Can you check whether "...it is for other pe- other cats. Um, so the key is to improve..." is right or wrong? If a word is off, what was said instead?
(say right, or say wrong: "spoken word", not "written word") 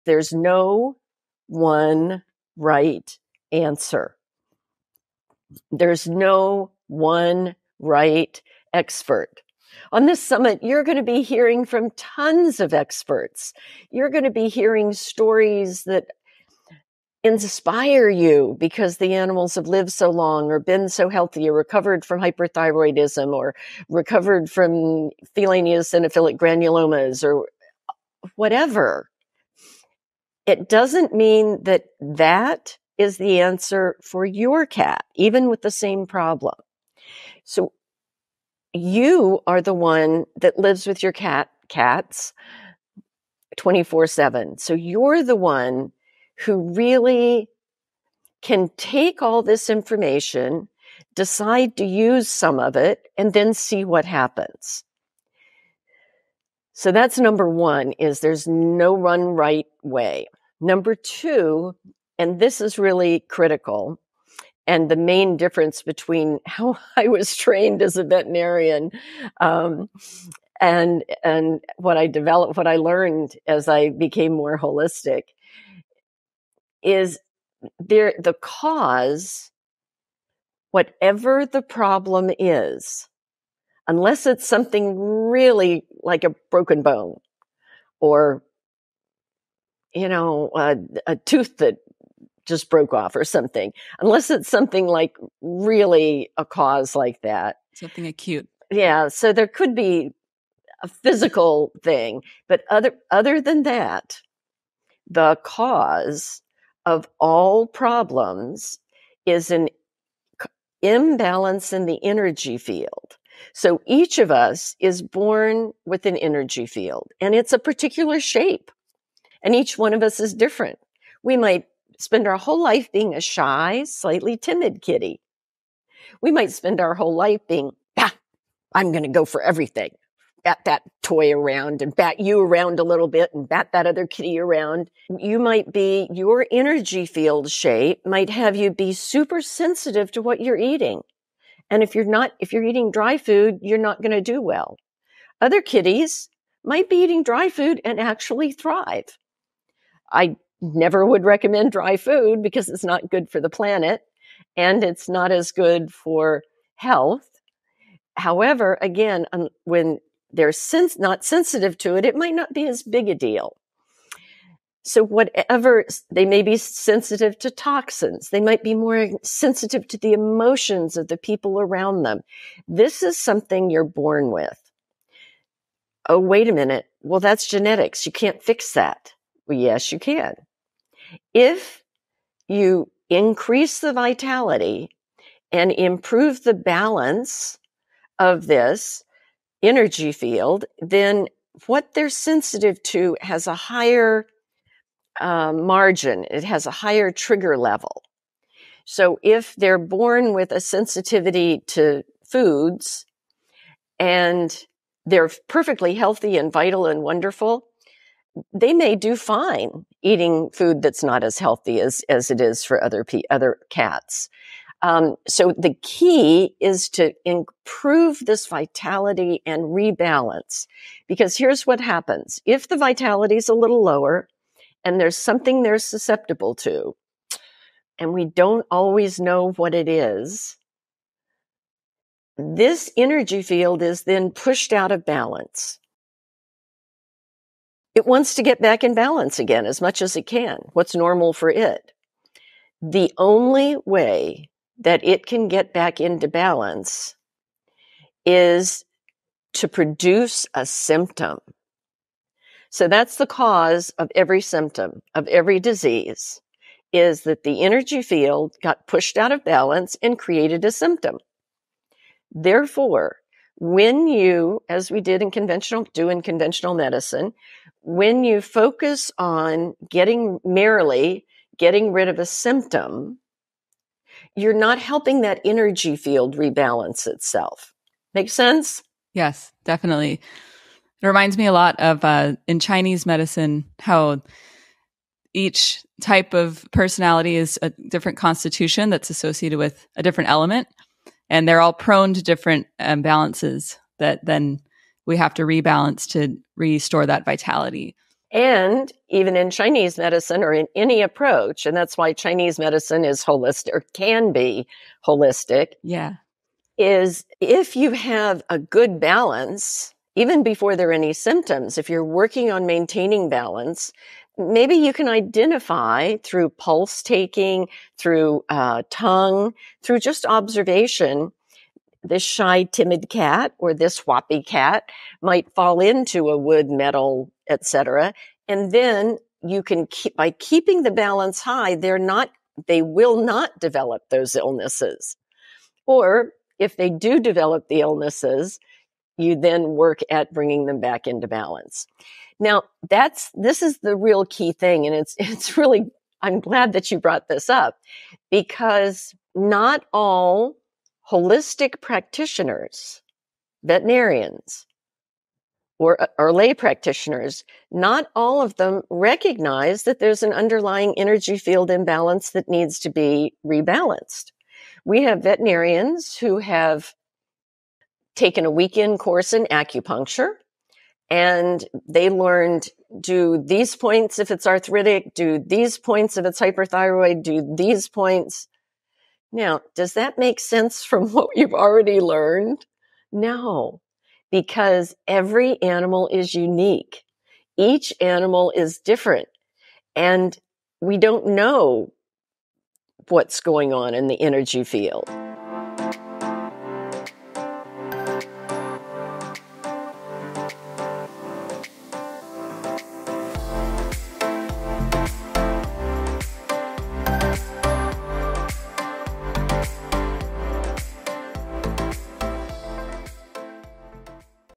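right.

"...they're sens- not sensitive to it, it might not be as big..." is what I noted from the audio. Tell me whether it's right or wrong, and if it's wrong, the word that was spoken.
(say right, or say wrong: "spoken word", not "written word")
right.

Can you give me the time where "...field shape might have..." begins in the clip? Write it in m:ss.
2:17.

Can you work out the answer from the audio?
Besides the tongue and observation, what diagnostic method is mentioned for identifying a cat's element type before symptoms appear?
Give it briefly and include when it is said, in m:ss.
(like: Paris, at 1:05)
Pulse taking, at 5:16.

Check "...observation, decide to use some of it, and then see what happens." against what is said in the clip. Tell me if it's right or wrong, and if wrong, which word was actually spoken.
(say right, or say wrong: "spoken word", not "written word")
wrong: "information", not "observation".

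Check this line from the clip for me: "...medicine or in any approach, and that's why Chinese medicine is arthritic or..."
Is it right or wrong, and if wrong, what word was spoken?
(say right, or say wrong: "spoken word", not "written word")
wrong: "holistic", not "arthritic".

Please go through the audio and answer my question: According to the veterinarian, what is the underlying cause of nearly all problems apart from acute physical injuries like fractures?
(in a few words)
An imbalance in the energy field.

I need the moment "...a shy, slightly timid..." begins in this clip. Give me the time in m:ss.
2:03.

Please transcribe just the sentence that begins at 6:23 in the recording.
No, because every animal is unique.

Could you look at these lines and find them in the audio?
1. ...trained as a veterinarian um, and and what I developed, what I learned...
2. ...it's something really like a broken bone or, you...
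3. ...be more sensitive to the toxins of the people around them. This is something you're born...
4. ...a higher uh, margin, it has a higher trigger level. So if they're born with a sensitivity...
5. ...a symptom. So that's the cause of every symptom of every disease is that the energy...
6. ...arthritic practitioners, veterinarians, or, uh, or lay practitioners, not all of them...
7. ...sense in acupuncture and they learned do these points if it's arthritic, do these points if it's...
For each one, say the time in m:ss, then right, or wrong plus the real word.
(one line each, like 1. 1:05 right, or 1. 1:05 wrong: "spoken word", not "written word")
1. 1:07 right
2. 1:24 right
3. 2:48 wrong: "emotions", not "toxins"
4. 3:13 right
5. 4:10 right
6. 5:51 wrong: "holistic", not "arthritic"
7. 6:08 wrong: "course", not "sense".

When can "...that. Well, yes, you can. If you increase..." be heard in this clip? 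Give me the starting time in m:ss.
2:58.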